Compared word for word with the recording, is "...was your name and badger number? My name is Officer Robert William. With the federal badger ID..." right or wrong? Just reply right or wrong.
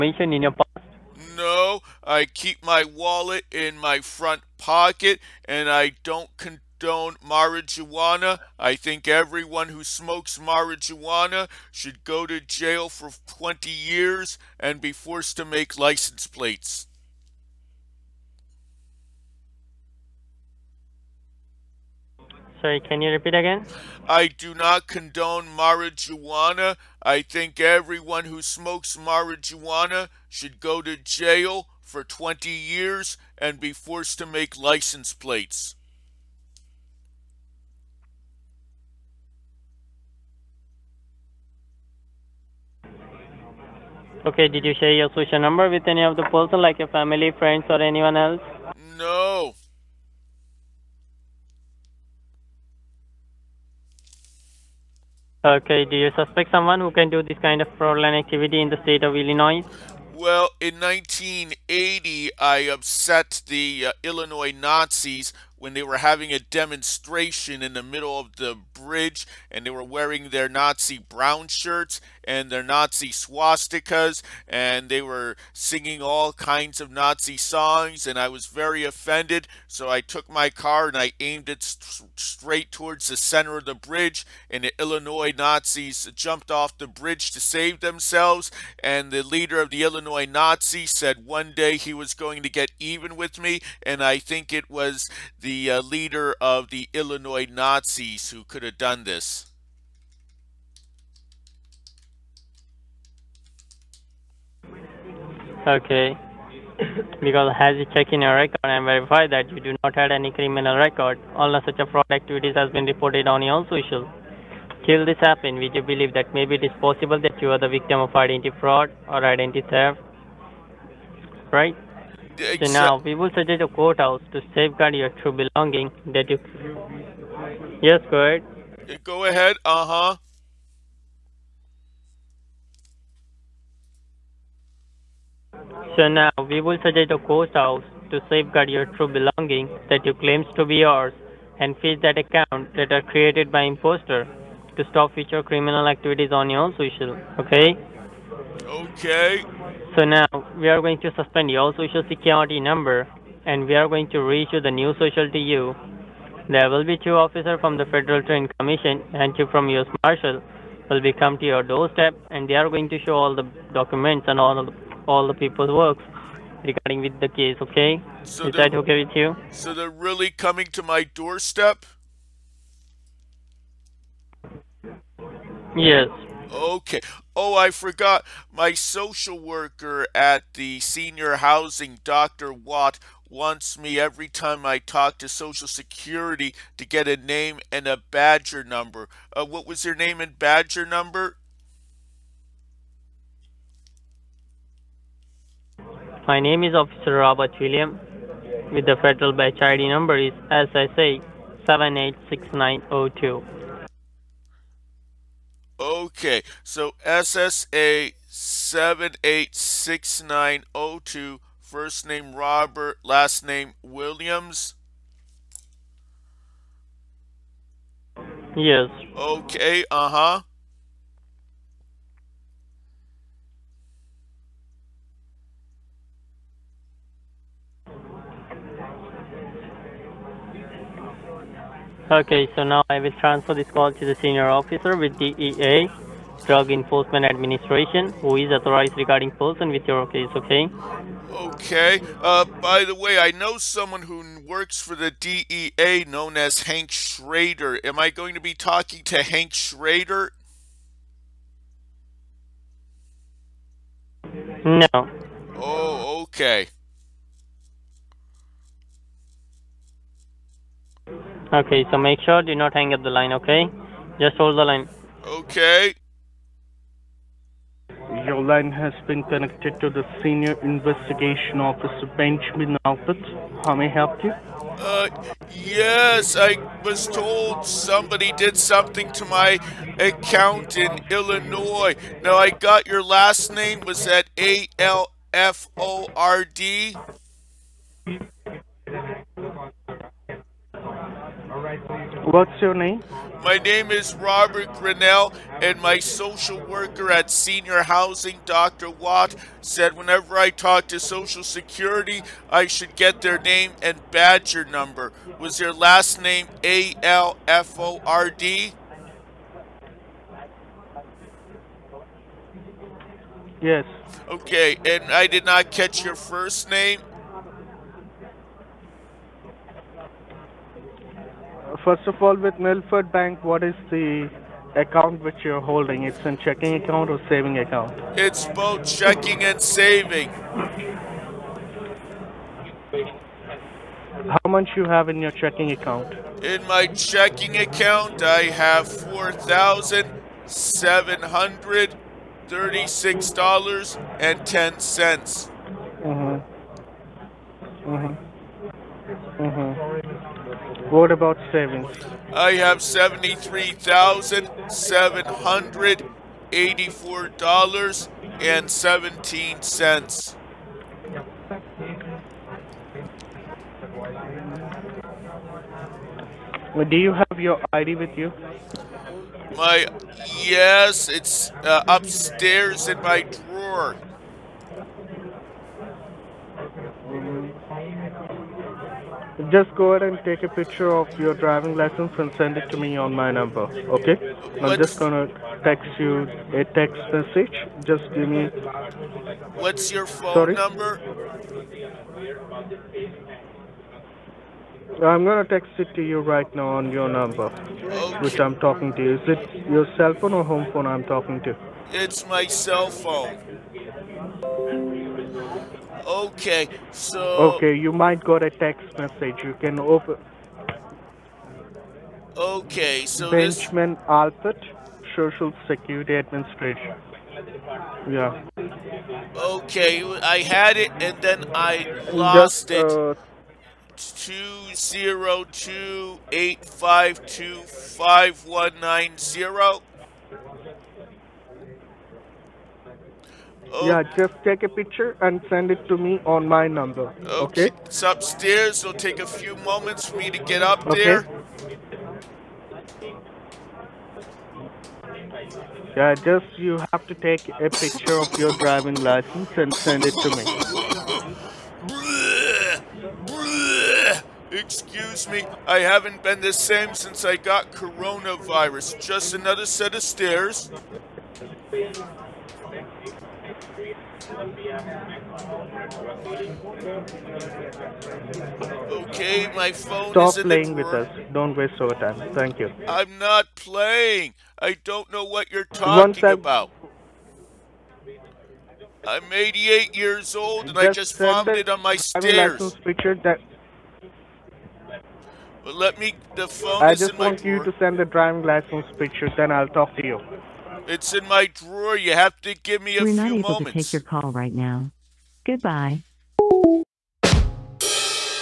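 right.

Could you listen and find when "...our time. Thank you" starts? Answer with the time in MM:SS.
07:51.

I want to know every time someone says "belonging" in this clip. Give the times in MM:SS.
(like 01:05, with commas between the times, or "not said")
02:05, 02:19.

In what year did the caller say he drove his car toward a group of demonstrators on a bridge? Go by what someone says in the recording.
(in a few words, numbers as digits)
1980.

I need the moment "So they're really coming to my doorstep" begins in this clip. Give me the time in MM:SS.
02:49.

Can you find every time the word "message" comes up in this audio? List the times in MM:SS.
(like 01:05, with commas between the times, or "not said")
06:27, 06:48.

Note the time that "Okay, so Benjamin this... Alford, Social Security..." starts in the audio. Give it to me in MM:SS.
06:52.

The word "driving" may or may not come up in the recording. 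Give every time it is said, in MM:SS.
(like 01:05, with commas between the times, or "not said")
06:21, 07:28, 08:08.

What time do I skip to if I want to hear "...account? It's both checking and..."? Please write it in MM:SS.
05:27.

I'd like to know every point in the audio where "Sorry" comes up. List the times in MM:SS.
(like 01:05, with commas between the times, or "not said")
00:22, 06:30.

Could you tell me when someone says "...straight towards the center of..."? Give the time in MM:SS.
01:22.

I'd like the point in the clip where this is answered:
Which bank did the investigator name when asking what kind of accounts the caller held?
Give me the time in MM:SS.
05:22.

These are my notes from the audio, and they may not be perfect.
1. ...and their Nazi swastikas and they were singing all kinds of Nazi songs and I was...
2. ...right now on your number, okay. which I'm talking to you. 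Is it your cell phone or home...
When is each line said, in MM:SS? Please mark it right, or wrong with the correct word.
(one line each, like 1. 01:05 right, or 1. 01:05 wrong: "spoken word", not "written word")
1. 01:12 right
2. 06:36 right.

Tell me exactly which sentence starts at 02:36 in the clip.
There will be two officers from the Federal Trade Commission and two from U.S.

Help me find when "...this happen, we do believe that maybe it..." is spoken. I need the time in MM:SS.
01:55.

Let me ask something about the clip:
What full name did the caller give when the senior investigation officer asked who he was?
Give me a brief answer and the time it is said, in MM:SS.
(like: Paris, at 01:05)
Robert Grinnell, at 04:54.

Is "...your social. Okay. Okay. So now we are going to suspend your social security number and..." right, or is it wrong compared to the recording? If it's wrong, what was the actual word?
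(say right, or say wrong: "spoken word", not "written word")
right.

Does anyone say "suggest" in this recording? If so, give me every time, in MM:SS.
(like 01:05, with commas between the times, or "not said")
02:03, 02:16.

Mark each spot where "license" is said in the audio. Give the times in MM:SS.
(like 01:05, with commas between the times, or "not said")
00:15, 00:34, 06:21, 07:28, 08:02, 08:08.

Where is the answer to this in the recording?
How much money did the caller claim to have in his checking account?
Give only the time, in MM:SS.
05:38.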